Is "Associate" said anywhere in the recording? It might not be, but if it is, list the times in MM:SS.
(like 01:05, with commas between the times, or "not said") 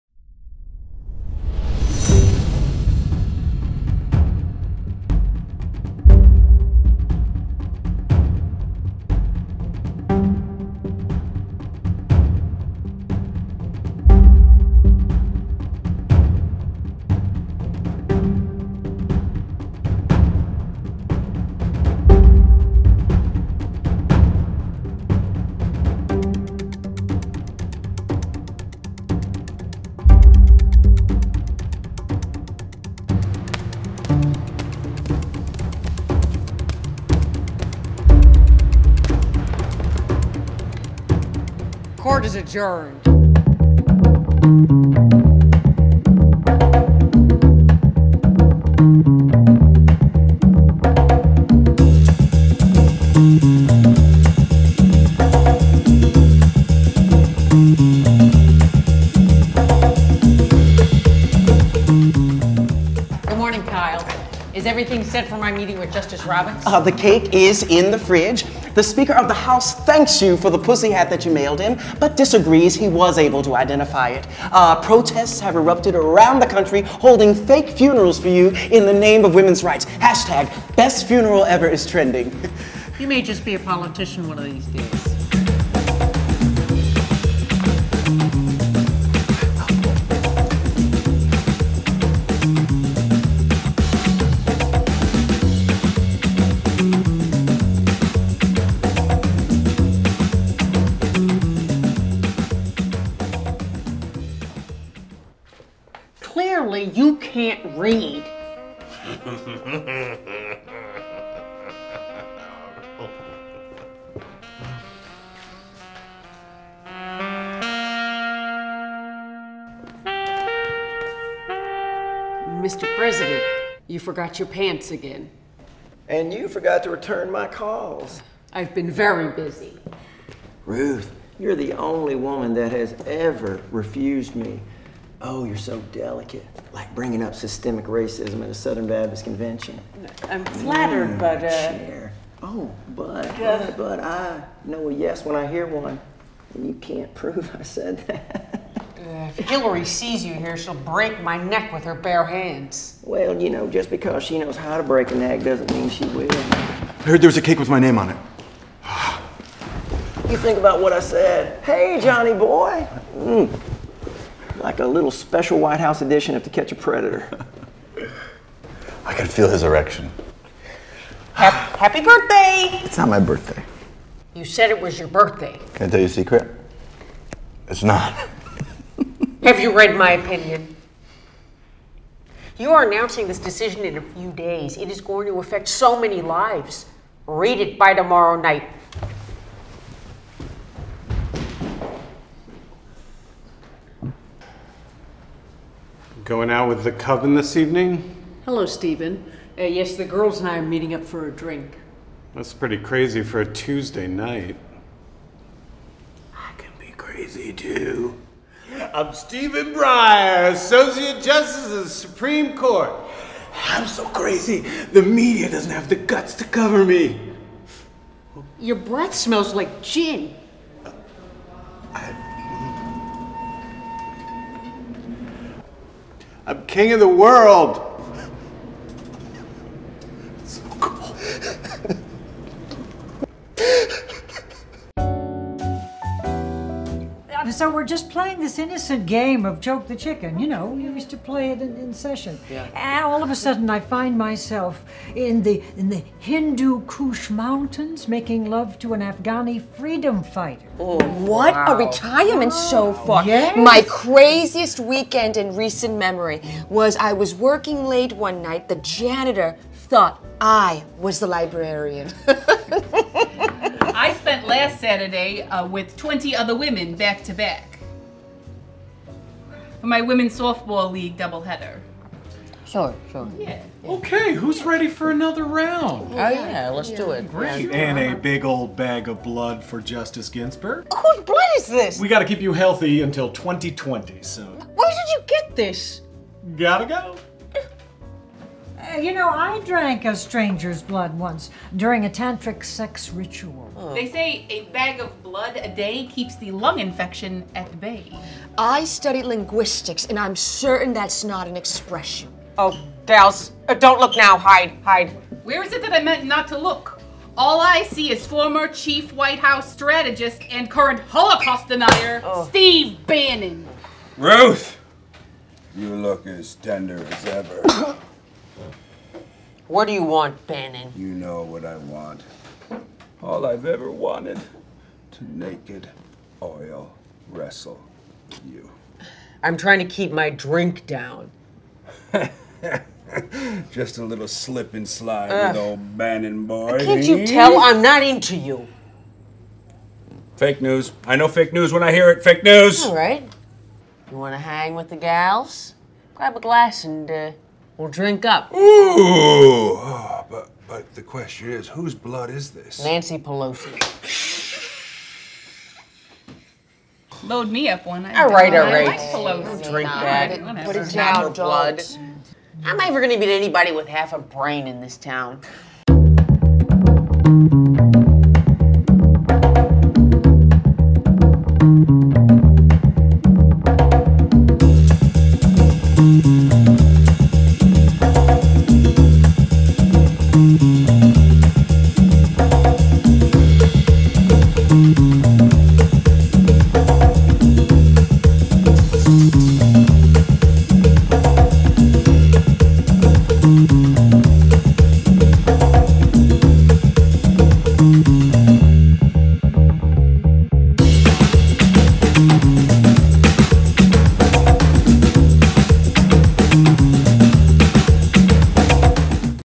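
03:30.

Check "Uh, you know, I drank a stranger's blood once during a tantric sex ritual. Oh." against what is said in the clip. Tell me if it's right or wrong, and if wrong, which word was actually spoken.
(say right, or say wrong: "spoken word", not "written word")
right.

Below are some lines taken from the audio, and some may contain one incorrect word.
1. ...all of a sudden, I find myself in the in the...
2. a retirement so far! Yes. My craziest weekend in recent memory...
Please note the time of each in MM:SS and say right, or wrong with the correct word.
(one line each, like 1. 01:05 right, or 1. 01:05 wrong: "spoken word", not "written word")
1. 04:03 right
2. 04:11 right.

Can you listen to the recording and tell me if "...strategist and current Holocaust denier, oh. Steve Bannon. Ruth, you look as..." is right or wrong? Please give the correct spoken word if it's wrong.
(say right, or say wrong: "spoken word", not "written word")
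right.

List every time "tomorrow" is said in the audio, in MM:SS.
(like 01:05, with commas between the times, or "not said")
03:07.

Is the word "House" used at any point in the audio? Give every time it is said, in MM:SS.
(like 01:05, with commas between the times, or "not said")
01:09, 02:45, 05:09.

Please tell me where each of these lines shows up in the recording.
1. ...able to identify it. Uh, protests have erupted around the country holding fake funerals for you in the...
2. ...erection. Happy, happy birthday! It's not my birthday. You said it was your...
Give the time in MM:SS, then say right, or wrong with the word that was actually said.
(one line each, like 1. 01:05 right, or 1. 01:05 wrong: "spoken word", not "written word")
1. 01:13 right
2. 02:49 right.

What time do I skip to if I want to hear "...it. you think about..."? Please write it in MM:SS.
02:38.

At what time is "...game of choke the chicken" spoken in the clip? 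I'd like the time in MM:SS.
03:59.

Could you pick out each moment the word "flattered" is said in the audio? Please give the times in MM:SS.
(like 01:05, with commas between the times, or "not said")
02:20.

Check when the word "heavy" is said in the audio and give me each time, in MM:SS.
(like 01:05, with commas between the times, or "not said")
not said.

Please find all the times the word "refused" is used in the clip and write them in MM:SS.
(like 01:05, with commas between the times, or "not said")
02:13.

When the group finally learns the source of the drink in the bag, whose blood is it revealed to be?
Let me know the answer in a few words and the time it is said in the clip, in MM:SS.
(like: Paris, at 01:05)
Nancy Pelosi, at 05:52.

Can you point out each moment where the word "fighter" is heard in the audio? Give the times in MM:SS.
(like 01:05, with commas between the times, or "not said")
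04:10.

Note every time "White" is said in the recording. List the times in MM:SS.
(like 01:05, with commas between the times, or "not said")
02:45, 05:09.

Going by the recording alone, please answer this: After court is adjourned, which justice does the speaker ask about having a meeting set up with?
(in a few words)
Justice Roberts.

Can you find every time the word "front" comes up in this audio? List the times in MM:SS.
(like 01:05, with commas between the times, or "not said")
not said.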